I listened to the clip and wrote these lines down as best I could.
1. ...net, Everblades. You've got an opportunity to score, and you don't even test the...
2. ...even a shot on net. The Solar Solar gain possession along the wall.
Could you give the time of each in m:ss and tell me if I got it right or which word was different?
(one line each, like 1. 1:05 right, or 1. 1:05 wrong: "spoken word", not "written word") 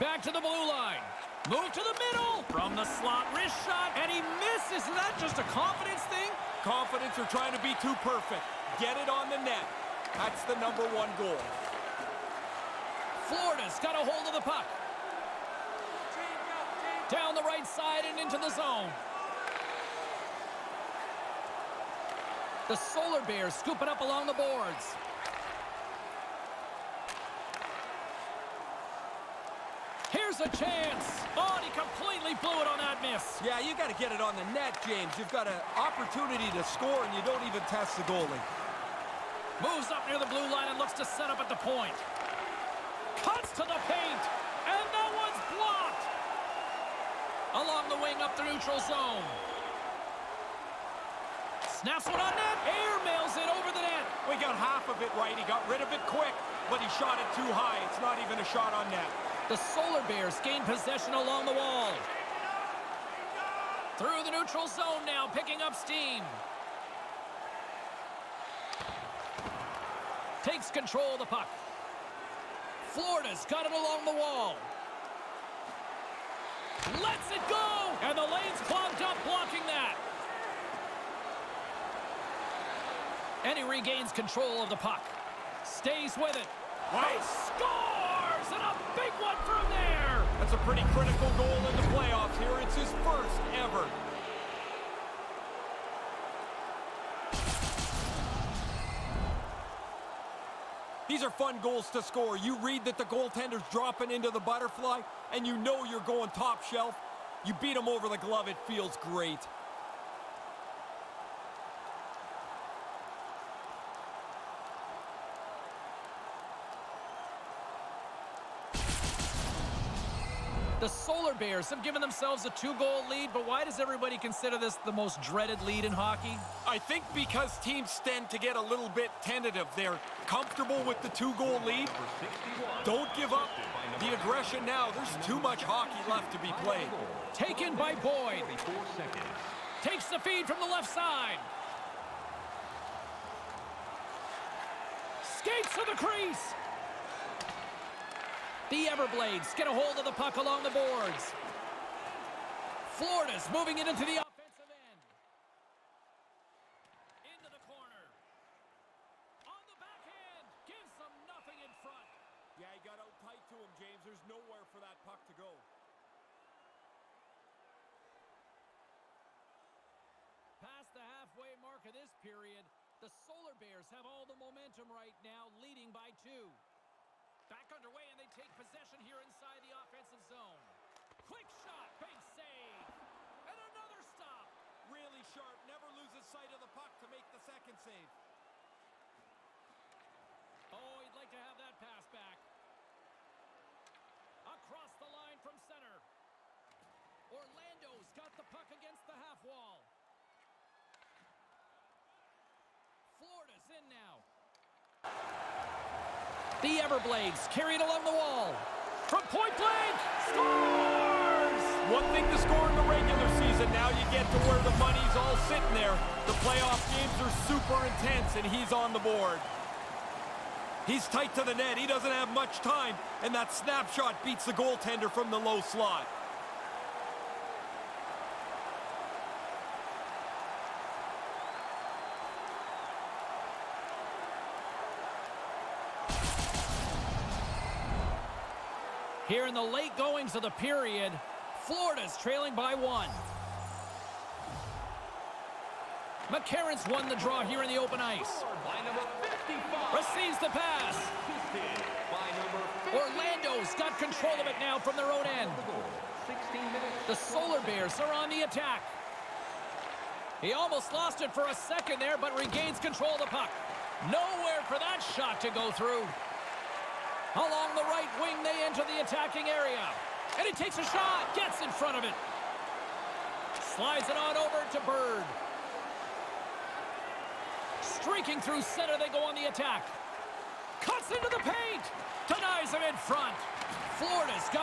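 1. 0:34 wrong: "James", not "Everblades"
2. 0:58 wrong: "Bears", not "Solar".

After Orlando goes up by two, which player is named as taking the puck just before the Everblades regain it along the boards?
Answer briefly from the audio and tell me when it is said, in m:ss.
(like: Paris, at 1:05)
Boyd, at 2:17.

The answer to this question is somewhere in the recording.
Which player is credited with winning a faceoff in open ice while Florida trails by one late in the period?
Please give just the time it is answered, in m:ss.
4:06.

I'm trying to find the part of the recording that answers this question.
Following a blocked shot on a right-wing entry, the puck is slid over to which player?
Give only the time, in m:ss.
4:34.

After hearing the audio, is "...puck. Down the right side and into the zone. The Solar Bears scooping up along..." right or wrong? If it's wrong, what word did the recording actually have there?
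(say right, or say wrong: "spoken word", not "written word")
right.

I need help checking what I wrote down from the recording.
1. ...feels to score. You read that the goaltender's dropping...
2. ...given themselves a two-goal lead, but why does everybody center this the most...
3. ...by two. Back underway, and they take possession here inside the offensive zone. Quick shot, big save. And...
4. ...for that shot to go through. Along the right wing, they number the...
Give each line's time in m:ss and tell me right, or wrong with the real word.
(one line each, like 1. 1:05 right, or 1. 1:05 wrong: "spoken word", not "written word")
1. 1:41 wrong: "goals", not "feels"
2. 2:01 wrong: "consider", not "center"
3. 2:55 right
4. 4:24 wrong: "enter", not "number".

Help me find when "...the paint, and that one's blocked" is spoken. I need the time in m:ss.
0:43.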